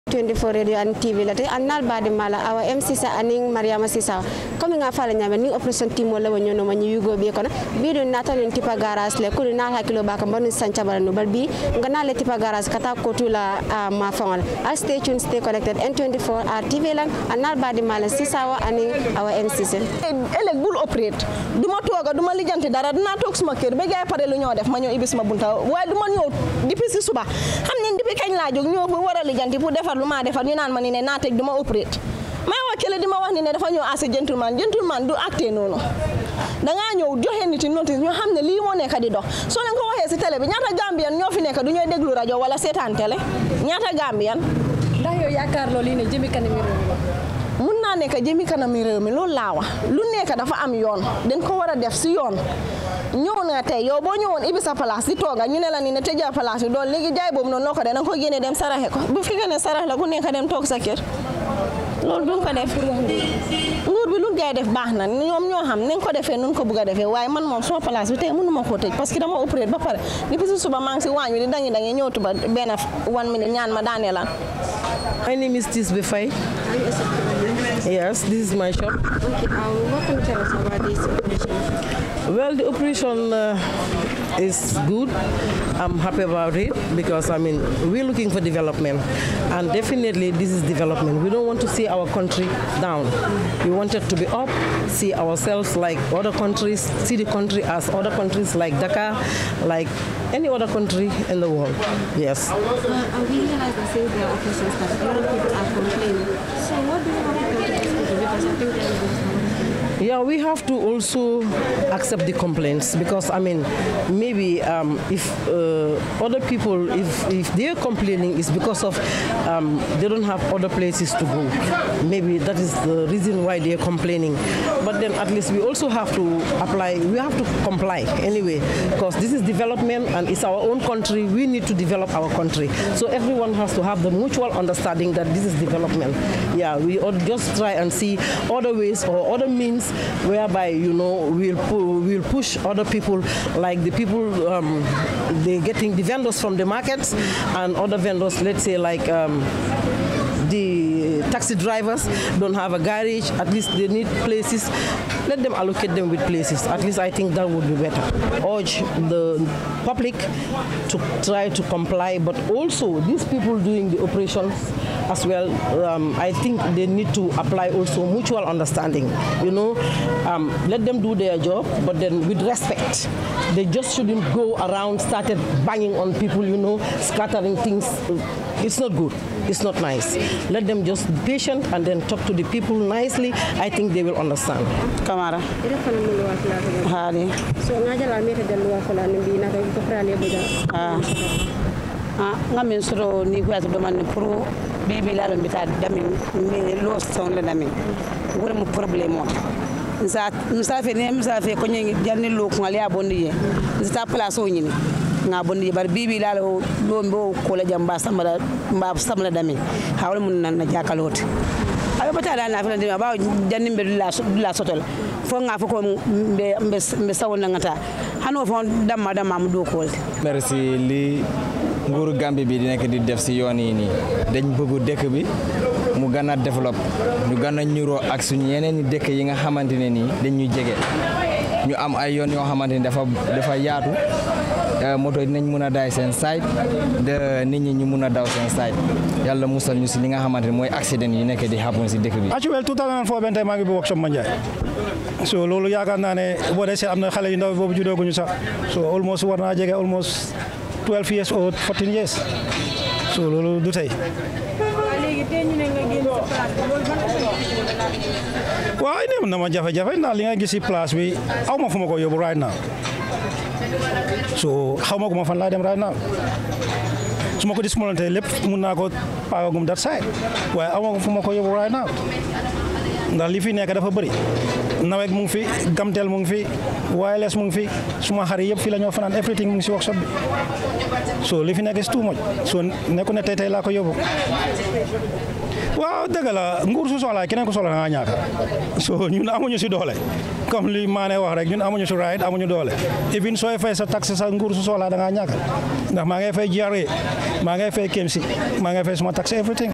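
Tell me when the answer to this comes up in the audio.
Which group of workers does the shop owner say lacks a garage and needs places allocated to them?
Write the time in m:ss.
2:31.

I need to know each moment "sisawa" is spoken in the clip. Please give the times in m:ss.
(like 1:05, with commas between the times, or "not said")
0:03, 0:18.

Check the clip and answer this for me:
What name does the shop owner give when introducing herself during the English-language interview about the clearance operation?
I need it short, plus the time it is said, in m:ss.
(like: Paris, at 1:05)
Tisbe Faye, at 1:15.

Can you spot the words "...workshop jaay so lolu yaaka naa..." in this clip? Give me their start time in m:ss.
4:03.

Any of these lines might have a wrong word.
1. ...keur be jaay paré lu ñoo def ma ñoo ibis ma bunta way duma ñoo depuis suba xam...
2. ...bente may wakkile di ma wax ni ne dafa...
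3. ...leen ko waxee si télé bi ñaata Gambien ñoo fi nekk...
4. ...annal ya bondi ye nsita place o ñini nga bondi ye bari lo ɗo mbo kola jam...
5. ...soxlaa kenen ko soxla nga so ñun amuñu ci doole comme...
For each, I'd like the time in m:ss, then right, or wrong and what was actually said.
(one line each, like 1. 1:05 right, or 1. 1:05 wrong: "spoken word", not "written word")
1. 0:23 right
2. 0:31 wrong: "operate", not "bente"
3. 0:39 right
4. 3:22 wrong: "lokungal", not "annal"
5. 4:46 right.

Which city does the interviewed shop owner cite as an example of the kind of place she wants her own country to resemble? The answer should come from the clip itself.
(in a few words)
Dakar.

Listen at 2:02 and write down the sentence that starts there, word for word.
Maybe that is the reason why they're complaining.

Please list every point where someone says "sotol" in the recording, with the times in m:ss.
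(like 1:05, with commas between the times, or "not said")
3:34.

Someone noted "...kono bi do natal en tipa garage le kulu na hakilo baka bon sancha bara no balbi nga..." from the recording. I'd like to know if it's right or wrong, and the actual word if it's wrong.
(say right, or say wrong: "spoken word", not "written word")
right.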